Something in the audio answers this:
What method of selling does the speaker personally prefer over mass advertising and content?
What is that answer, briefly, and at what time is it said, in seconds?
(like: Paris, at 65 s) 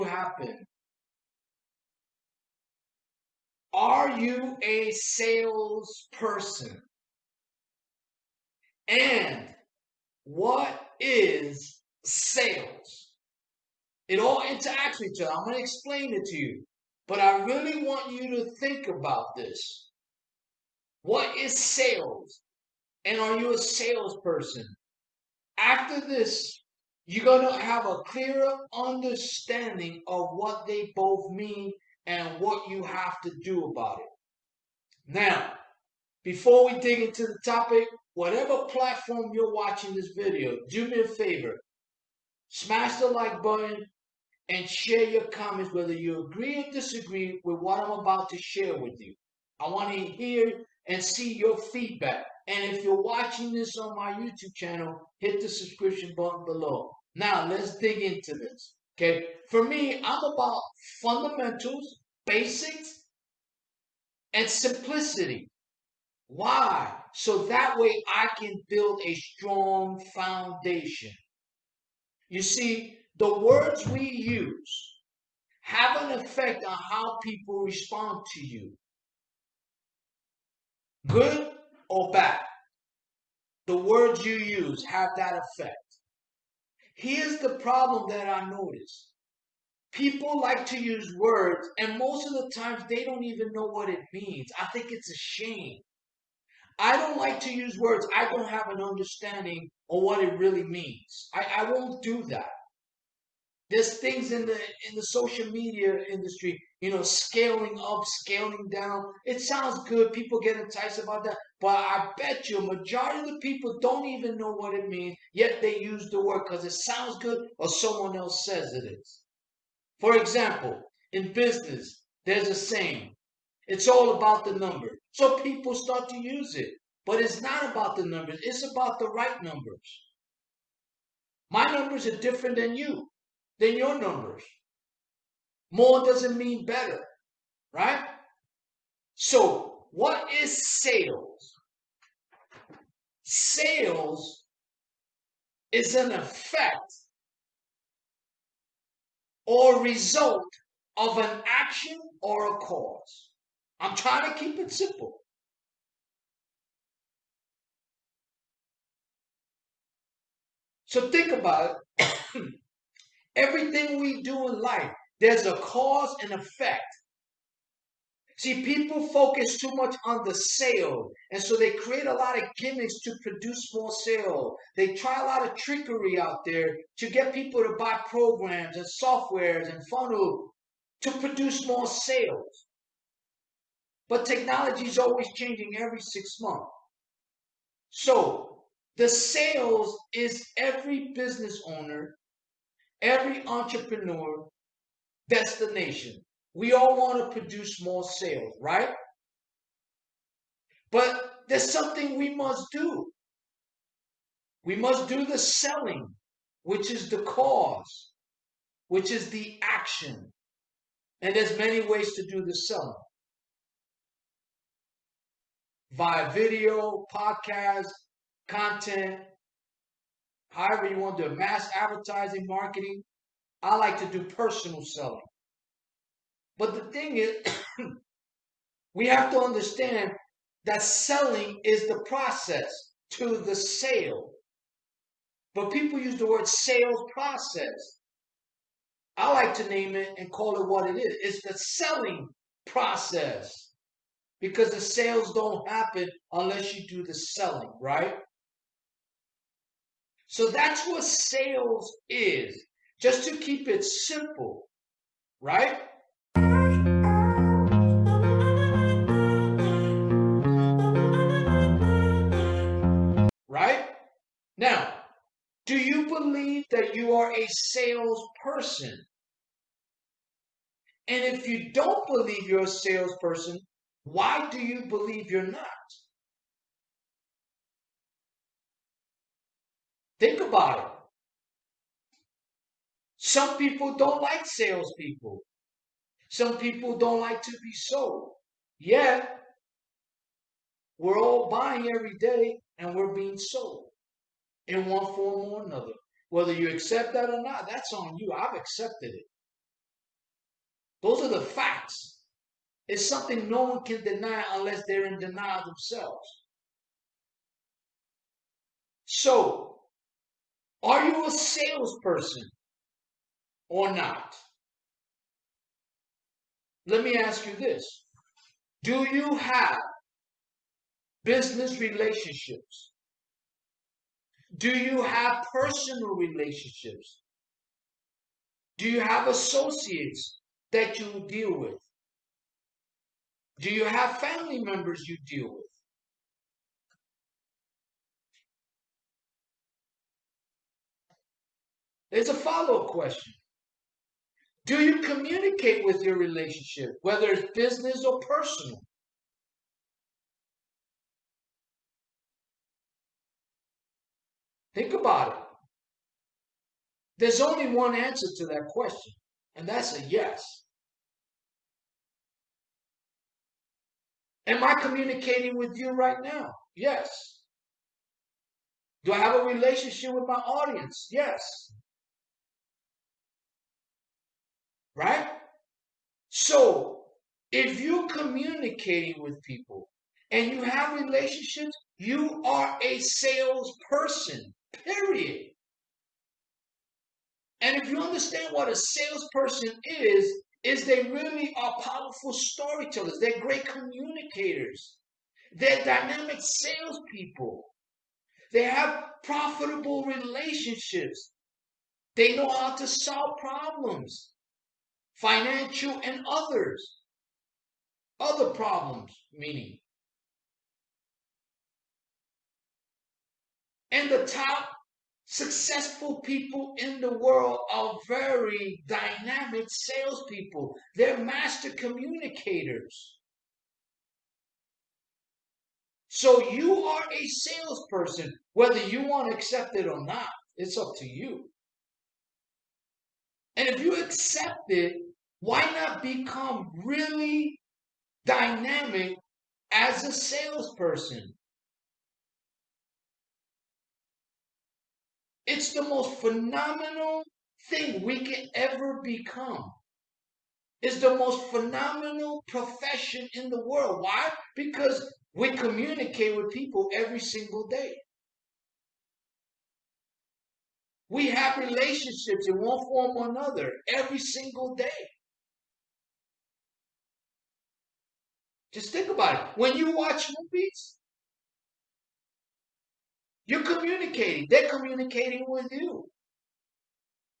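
personal selling, at 224 s.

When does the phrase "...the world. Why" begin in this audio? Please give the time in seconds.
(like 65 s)
453 s.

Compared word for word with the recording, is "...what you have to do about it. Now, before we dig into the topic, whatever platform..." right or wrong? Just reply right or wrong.
right.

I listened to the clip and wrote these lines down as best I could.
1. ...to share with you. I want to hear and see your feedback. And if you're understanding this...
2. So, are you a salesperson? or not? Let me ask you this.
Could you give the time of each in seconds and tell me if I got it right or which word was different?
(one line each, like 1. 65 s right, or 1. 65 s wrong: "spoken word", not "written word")
1. 48 s wrong: "watching", not "understanding"
2. 309 s right.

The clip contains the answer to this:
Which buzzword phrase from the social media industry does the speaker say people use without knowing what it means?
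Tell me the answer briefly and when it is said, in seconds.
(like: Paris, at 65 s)
scaling up, at 107 s.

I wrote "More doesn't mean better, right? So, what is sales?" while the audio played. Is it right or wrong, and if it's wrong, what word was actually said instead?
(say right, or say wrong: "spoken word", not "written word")
right.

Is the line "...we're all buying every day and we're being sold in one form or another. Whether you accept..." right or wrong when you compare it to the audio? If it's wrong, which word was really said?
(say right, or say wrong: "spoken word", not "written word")
right.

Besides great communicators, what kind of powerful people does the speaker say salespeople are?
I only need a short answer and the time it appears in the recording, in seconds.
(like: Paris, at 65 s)
storytellers, at 392 s.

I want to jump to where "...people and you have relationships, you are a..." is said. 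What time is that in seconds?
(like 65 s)
379 s.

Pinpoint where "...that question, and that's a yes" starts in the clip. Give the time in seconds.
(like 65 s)
358 s.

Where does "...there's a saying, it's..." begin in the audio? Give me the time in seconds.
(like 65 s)
122 s.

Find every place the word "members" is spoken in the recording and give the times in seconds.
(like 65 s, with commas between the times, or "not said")
334 s.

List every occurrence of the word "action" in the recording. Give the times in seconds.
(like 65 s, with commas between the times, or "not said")
151 s, 209 s.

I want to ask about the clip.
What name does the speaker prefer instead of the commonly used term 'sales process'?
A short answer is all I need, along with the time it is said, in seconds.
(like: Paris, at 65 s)
selling process, at 241 s.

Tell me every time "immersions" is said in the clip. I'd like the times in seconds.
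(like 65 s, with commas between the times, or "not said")
not said.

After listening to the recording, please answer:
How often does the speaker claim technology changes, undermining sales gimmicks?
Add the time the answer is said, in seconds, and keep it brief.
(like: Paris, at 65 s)
every 6 months, at 185 s.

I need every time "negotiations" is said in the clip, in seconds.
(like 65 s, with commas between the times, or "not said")
not said.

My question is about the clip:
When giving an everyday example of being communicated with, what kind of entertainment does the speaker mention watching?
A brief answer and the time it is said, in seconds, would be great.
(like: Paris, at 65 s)
movies, at 470 s.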